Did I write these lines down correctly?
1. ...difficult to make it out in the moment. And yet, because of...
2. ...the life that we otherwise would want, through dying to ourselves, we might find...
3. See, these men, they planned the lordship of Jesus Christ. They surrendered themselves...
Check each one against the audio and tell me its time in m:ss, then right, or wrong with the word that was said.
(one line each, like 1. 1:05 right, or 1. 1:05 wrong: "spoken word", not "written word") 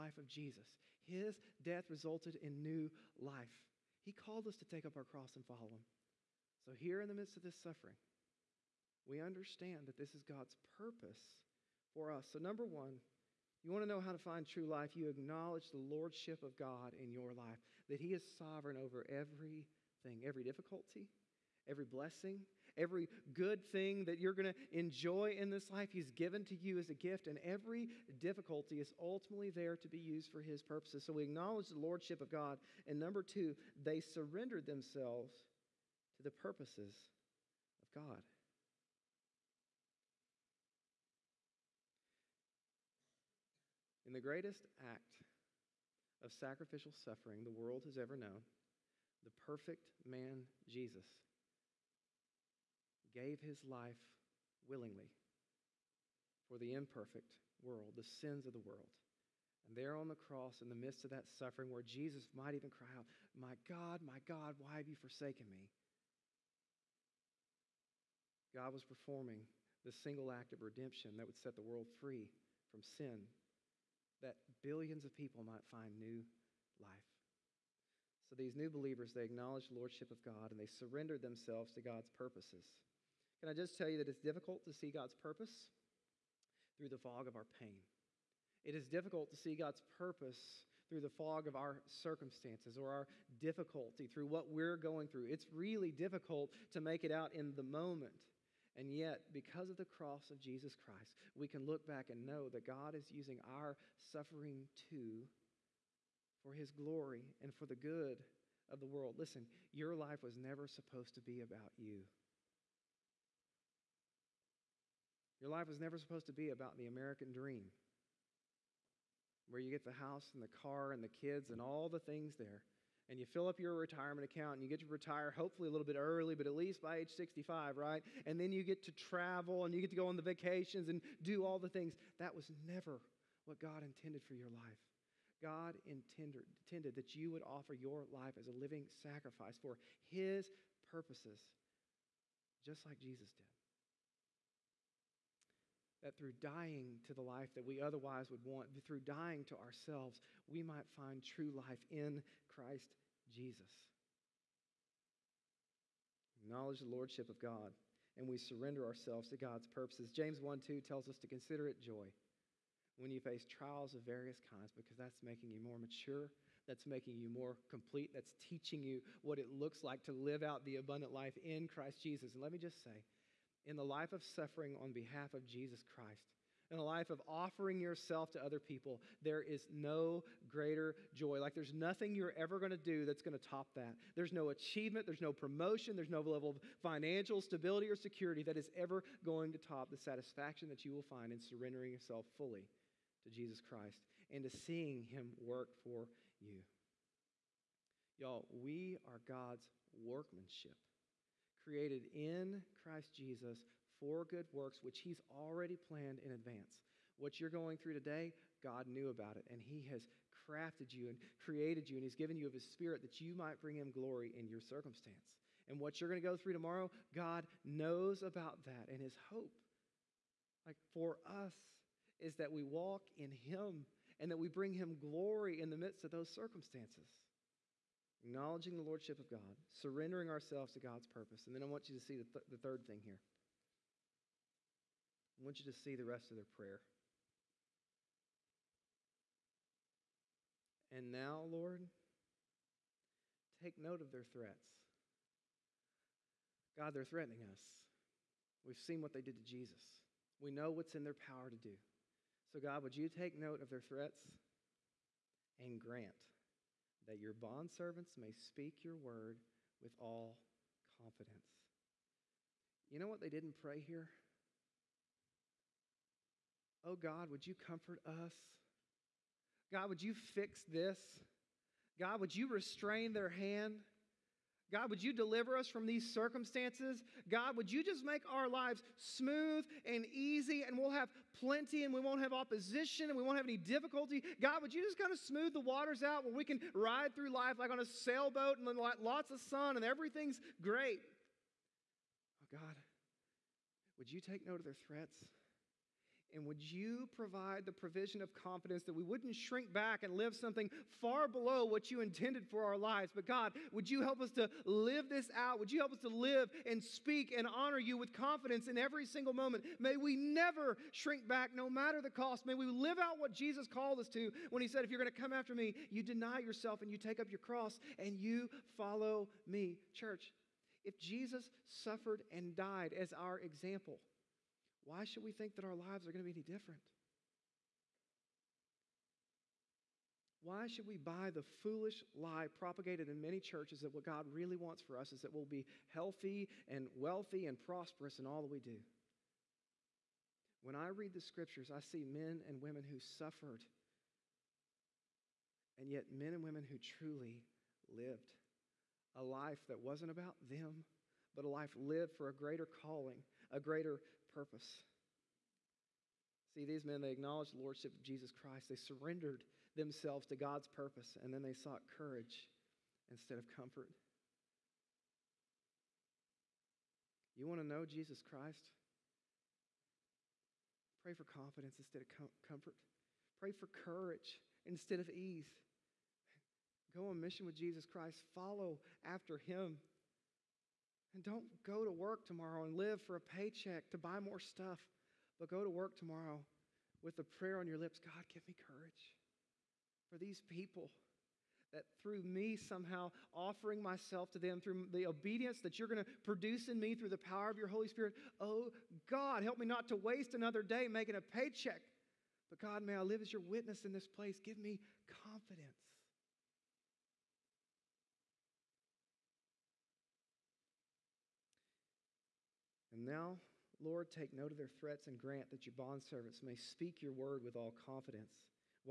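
1. 1:35 right
2. 2:27 right
3. 5:56 wrong: "acknowledged", not "planned".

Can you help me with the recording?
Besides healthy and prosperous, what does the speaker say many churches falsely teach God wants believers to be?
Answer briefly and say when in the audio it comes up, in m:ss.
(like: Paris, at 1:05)
Wealthy, at 5:36.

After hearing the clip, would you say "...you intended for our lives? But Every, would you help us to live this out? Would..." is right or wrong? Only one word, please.
wrong.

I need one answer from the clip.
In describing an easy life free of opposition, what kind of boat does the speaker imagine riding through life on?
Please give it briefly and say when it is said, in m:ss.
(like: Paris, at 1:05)
Sailboat, at 4:47.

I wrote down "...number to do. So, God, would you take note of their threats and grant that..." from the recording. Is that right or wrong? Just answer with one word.
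wrong.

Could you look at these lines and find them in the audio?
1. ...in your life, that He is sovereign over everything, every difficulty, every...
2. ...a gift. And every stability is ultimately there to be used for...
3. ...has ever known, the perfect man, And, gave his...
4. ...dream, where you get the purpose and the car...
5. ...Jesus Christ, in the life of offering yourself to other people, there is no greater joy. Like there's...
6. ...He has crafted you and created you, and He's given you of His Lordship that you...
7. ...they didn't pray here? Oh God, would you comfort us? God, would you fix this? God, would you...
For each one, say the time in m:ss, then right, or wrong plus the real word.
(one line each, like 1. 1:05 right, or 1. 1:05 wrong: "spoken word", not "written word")
1. 0:17 right
2. 0:26 wrong: "difficulty", not "stability"
3. 0:47 wrong: "Jesus", not "And"
4. 1:57 wrong: "house", not "purpose"
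5. 2:55 right
6. 3:29 wrong: "Spirit", not "Lordship"
7. 4:23 right.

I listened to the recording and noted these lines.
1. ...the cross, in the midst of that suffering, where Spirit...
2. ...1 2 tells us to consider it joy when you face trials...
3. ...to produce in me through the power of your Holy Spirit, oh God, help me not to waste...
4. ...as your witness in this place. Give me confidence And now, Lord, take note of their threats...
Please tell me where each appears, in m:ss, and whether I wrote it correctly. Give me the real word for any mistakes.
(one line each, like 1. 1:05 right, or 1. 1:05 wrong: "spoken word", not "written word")
1. 1:00 wrong: "Jesus", not "Spirit"
2. 2:40 right
3. 6:36 right
4. 6:43 right.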